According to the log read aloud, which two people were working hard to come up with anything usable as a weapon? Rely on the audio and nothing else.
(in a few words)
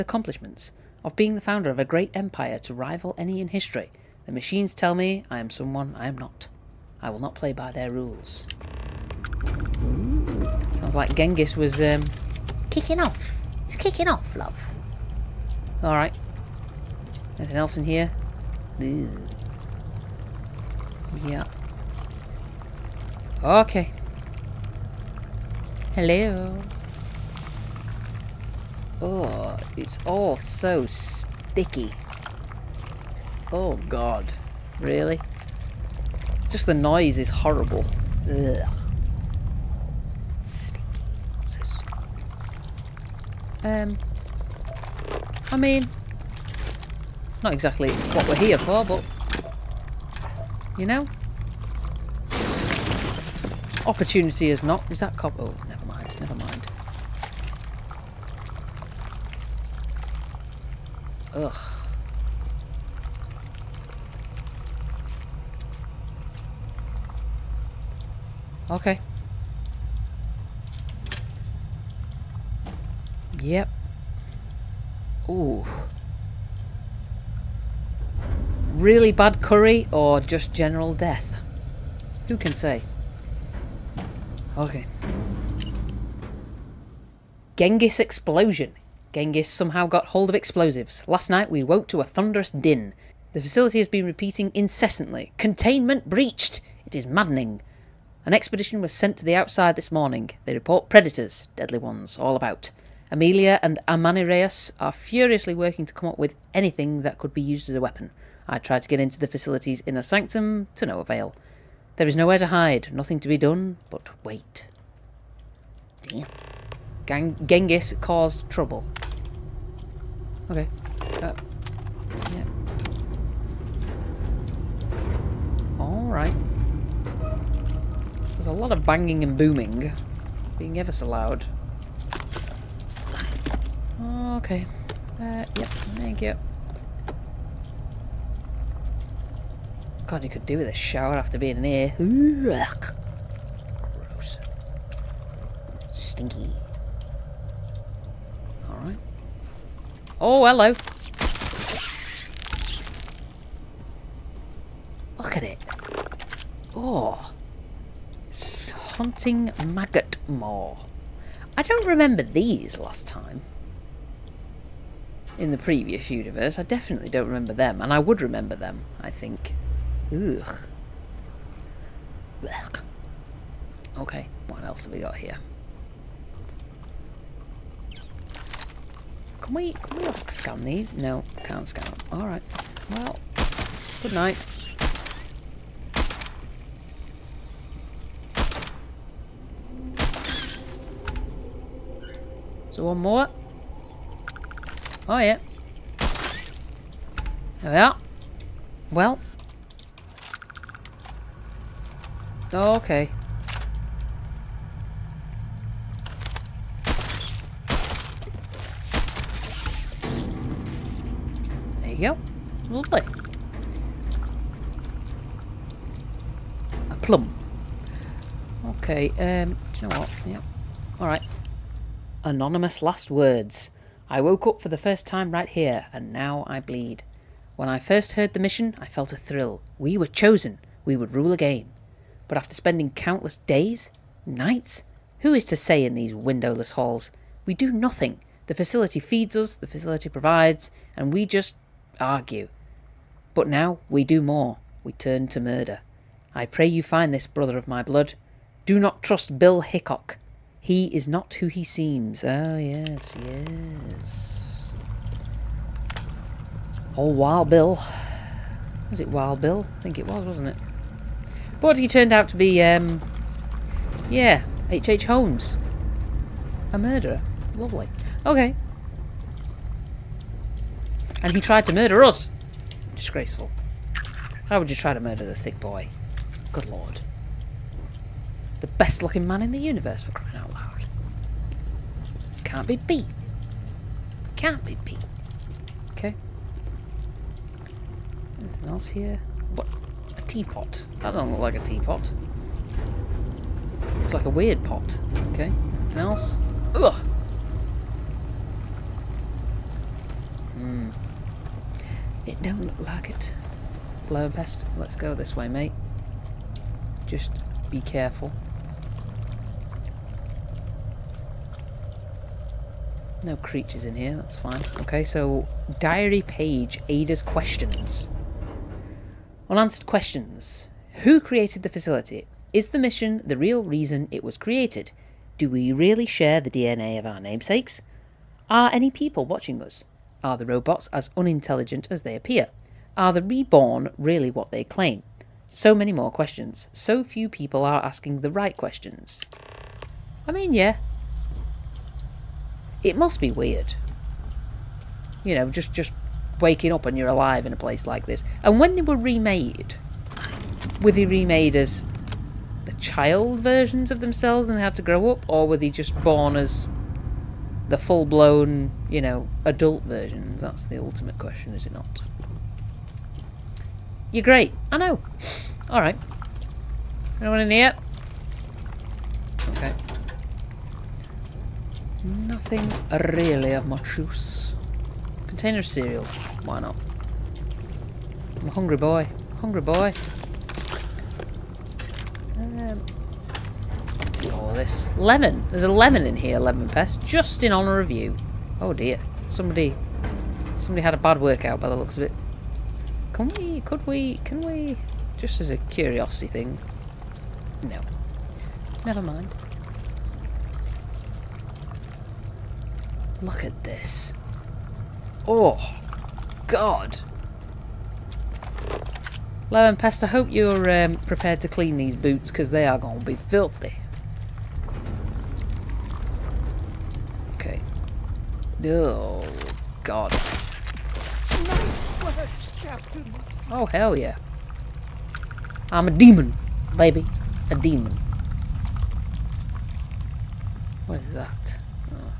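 Amelia and Amanirenas.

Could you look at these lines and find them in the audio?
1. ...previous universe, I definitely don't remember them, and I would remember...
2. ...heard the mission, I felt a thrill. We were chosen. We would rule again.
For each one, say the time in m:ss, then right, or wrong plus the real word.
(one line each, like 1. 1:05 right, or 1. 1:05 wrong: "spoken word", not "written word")
1. 2:45 right
2. 3:48 right.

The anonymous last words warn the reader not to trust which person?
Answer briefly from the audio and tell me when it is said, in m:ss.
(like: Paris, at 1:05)
Bill Hickok, at 4:09.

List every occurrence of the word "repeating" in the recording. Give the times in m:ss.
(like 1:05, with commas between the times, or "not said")
1:34.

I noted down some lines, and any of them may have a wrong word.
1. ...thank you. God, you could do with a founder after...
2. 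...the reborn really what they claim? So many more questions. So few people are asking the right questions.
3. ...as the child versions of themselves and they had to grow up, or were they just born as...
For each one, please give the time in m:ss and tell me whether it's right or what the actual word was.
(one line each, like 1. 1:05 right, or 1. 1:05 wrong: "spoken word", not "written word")
1. 2:15 wrong: "shower", not "founder"
2. 5:33 right
3. 5:51 right.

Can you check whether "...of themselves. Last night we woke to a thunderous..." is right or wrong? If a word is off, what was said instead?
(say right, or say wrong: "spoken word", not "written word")
wrong: "explosives", not "themselves".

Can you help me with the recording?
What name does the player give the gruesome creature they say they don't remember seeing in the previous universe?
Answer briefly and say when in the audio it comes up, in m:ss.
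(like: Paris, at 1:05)
haunting maggot maw, at 2:38.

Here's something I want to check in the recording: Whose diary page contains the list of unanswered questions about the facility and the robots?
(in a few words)
Ada.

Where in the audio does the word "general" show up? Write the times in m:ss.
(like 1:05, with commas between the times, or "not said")
1:20.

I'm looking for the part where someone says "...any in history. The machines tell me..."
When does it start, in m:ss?
0:03.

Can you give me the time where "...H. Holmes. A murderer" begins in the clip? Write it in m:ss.
4:25.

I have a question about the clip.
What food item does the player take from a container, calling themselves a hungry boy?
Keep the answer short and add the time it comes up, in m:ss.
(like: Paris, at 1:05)
Cereal, at 6:15.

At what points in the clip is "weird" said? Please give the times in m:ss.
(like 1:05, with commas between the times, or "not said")
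4:54, 5:43.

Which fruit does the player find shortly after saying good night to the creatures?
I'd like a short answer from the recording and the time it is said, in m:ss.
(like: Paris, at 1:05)
A plum, at 3:36.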